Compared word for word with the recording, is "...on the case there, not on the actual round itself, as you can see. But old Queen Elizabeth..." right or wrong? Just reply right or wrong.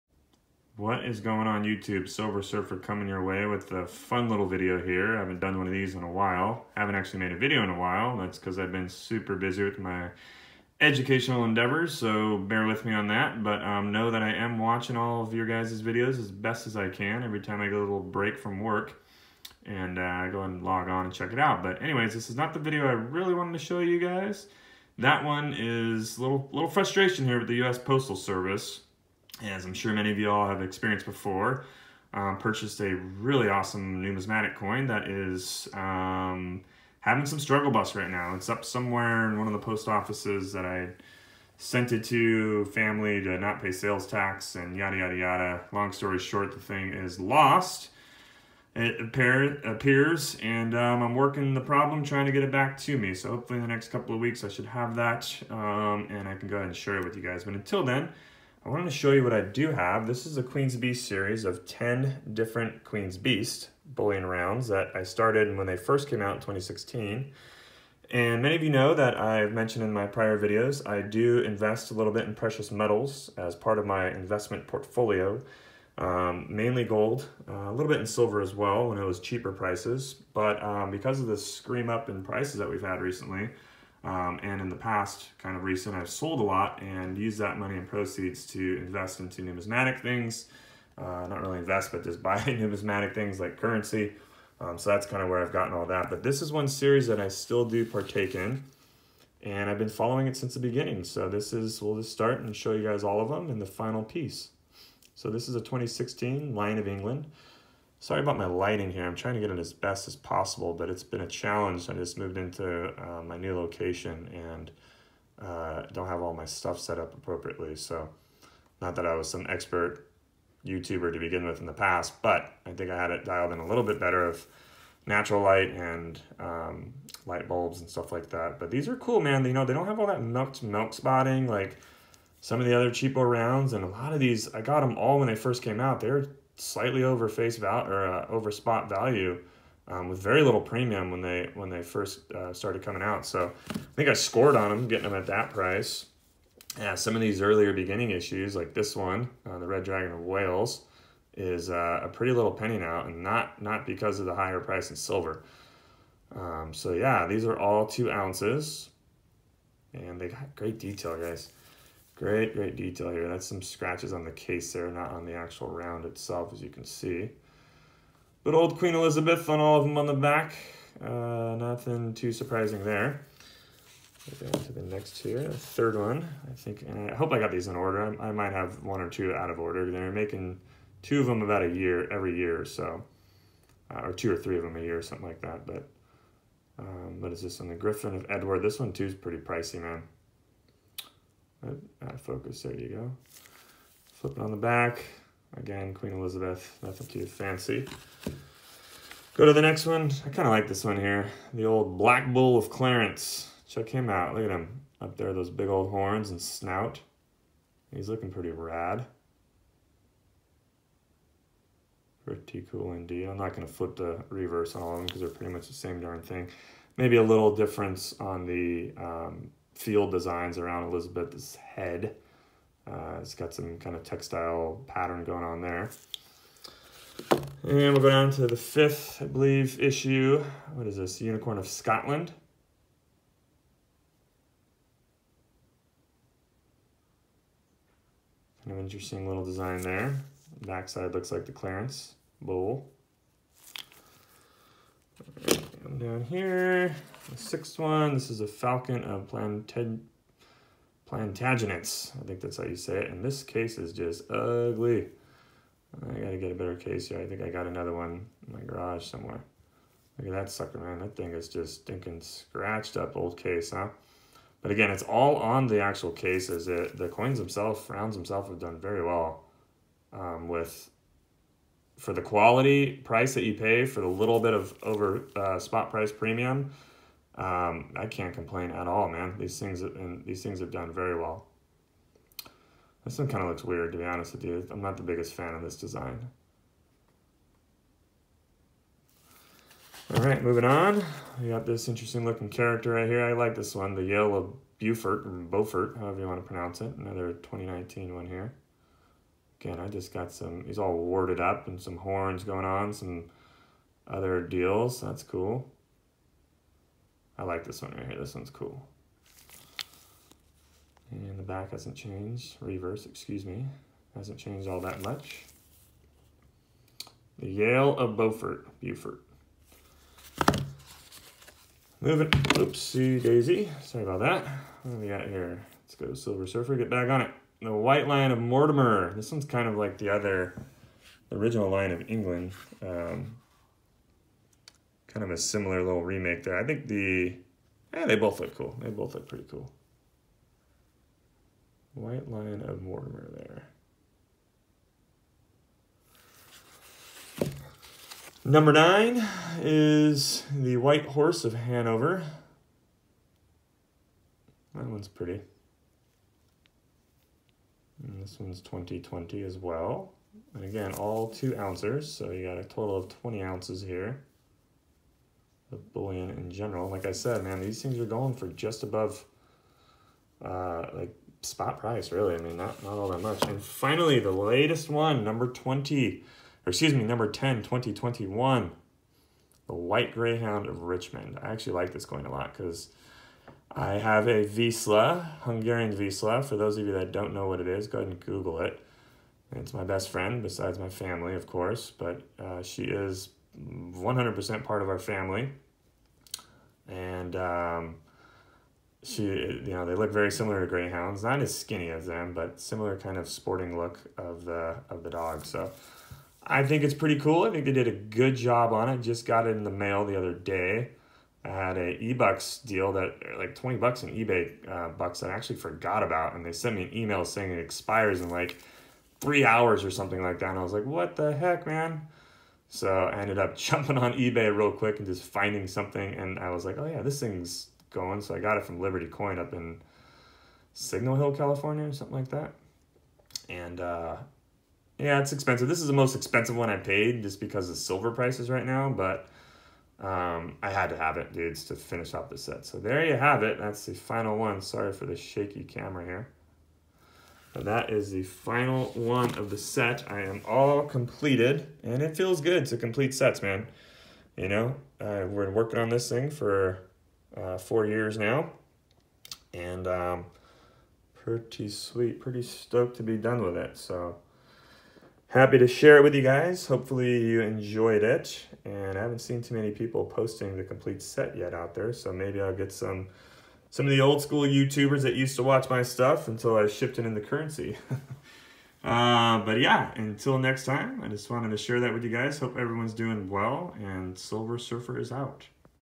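right.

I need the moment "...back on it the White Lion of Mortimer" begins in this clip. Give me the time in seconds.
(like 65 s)
326 s.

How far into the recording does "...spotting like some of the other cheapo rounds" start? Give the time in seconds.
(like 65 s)
130 s.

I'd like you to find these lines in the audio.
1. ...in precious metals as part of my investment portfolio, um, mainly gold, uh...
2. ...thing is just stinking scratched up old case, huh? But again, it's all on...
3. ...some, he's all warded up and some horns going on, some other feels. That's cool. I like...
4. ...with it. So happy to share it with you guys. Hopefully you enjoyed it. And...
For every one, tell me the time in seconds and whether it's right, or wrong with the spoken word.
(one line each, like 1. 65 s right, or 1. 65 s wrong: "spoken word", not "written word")
1. 72 s right
2. 261 s right
3. 300 s wrong: "deals", not "feels"
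4. 463 s right.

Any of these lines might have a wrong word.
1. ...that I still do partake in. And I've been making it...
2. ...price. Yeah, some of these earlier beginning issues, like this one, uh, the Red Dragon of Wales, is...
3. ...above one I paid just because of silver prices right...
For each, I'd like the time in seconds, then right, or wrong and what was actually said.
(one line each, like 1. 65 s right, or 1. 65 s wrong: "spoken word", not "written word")
1. 97 s wrong: "following", not "making"
2. 145 s right
3. 436 s wrong: "expensive", not "above".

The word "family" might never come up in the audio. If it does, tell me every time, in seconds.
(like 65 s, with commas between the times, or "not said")
42 s, 390 s, 394 s.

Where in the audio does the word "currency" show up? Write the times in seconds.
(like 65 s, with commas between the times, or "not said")
93 s, 477 s.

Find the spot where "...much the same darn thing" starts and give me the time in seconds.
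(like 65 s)
215 s.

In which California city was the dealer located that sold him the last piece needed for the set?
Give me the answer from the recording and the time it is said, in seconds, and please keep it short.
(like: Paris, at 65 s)
Signal Hill, at 430 s.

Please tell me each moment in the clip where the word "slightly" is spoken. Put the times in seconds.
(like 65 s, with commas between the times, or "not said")
136 s.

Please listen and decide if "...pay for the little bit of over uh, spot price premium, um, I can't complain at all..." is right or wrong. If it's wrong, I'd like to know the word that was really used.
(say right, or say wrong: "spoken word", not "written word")
right.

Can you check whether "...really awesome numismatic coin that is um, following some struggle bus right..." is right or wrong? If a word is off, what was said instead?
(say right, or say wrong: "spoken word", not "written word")
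wrong: "having", not "following".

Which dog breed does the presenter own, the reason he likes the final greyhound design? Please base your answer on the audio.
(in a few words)
Hungarian Vizsla.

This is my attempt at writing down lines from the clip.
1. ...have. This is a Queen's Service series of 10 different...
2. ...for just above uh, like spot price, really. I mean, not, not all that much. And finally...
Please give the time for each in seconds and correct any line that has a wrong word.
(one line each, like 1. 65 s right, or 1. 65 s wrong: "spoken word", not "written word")
1. 59 s wrong: "Beast", not "Service"
2. 368 s right.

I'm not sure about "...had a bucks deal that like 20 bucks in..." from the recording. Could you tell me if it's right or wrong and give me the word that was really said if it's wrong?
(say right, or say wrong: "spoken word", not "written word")
wrong: "eBucks", not "bucks".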